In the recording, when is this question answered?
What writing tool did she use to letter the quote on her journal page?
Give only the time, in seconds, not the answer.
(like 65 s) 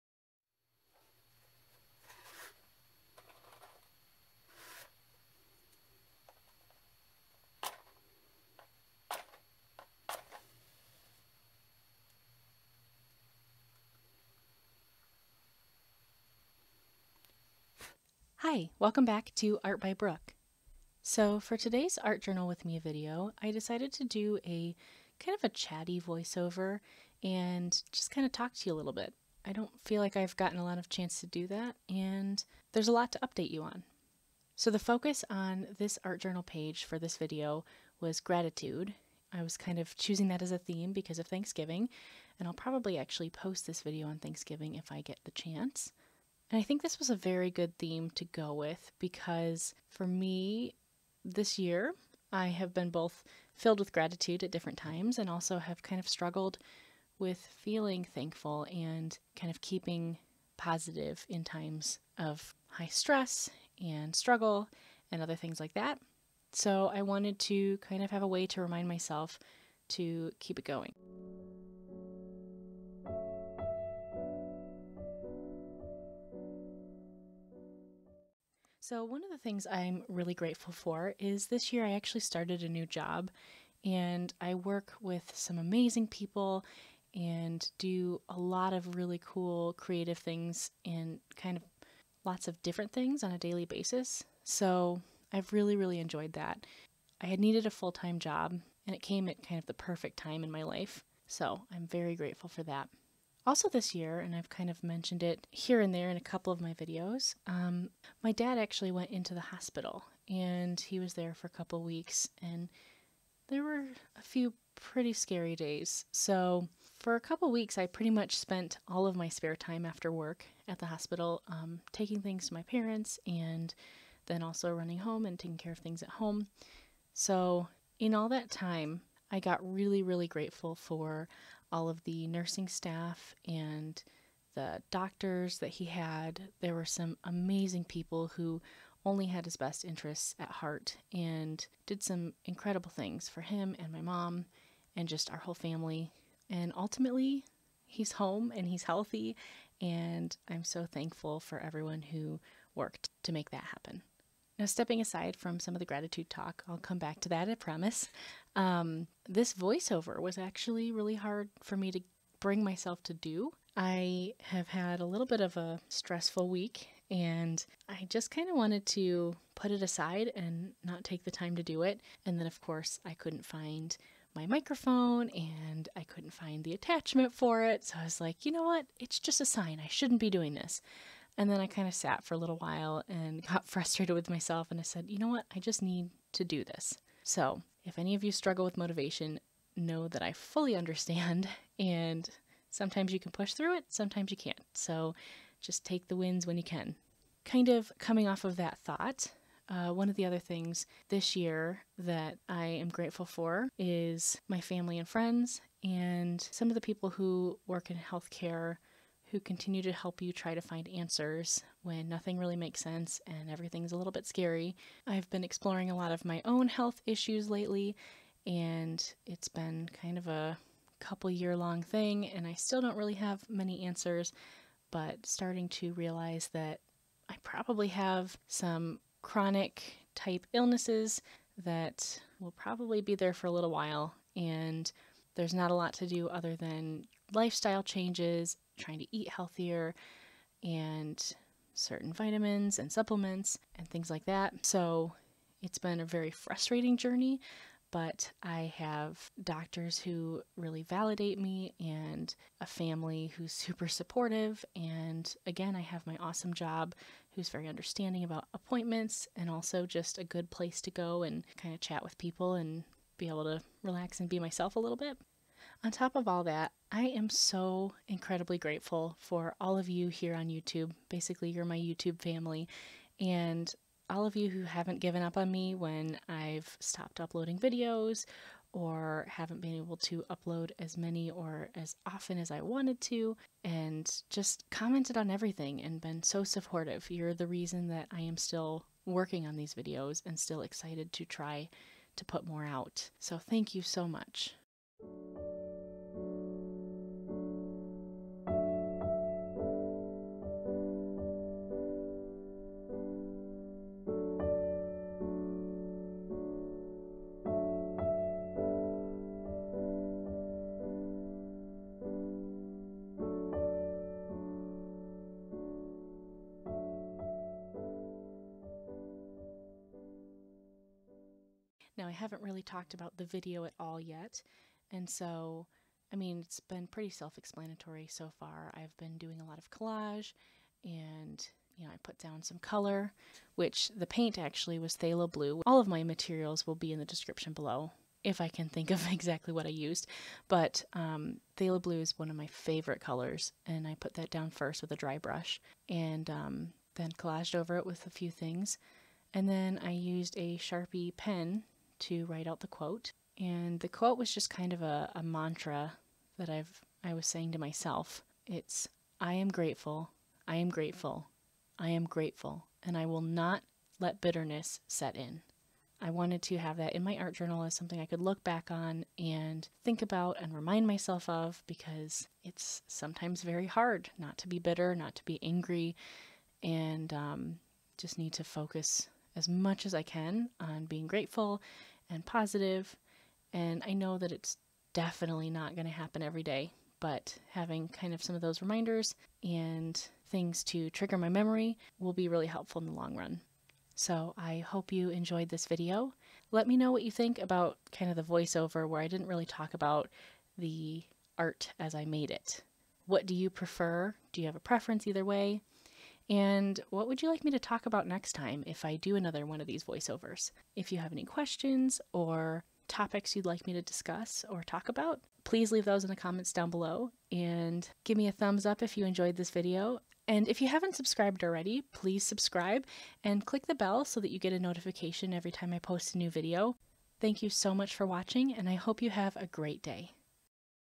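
350 s.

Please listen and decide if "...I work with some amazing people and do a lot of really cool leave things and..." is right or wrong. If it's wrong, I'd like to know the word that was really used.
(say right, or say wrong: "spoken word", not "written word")
wrong: "creative", not "leave".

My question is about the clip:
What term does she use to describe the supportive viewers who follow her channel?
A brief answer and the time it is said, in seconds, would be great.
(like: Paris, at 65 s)
YouTube family, at 271 s.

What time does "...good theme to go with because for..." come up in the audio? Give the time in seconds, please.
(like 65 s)
47 s.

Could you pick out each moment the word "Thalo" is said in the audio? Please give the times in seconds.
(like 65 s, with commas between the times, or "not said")
334 s, 341 s.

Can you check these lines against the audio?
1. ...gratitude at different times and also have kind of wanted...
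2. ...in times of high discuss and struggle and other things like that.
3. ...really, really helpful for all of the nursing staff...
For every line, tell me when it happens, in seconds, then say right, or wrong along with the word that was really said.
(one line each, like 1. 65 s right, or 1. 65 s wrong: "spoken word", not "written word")
1. 53 s wrong: "struggled", not "wanted"
2. 61 s wrong: "stress", not "discuss"
3. 129 s wrong: "grateful", not "helpful".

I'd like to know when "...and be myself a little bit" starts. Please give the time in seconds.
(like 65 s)
264 s.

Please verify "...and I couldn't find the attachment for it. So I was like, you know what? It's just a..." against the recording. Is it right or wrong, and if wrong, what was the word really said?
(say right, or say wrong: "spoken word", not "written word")
right.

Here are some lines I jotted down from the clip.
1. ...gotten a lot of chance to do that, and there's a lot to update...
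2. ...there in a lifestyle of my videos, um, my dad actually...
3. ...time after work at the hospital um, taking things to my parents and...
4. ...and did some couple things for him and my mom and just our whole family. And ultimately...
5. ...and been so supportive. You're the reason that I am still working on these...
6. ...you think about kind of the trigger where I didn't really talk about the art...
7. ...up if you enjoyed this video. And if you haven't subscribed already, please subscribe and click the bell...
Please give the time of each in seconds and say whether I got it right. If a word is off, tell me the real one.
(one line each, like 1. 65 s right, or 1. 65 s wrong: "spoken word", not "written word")
1. 30 s right
2. 105 s wrong: "couple", not "lifestyle"
3. 119 s right
4. 141 s wrong: "incredible", not "couple"
5. 285 s right
6. 397 s wrong: "voiceover", not "trigger"
7. 418 s right.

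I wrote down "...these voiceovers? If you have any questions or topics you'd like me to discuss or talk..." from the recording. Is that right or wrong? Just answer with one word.
right.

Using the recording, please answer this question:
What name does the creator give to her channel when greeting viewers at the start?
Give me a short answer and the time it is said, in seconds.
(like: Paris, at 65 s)
Art by Brooke, at 19 s.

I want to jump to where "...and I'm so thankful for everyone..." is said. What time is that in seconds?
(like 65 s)
149 s.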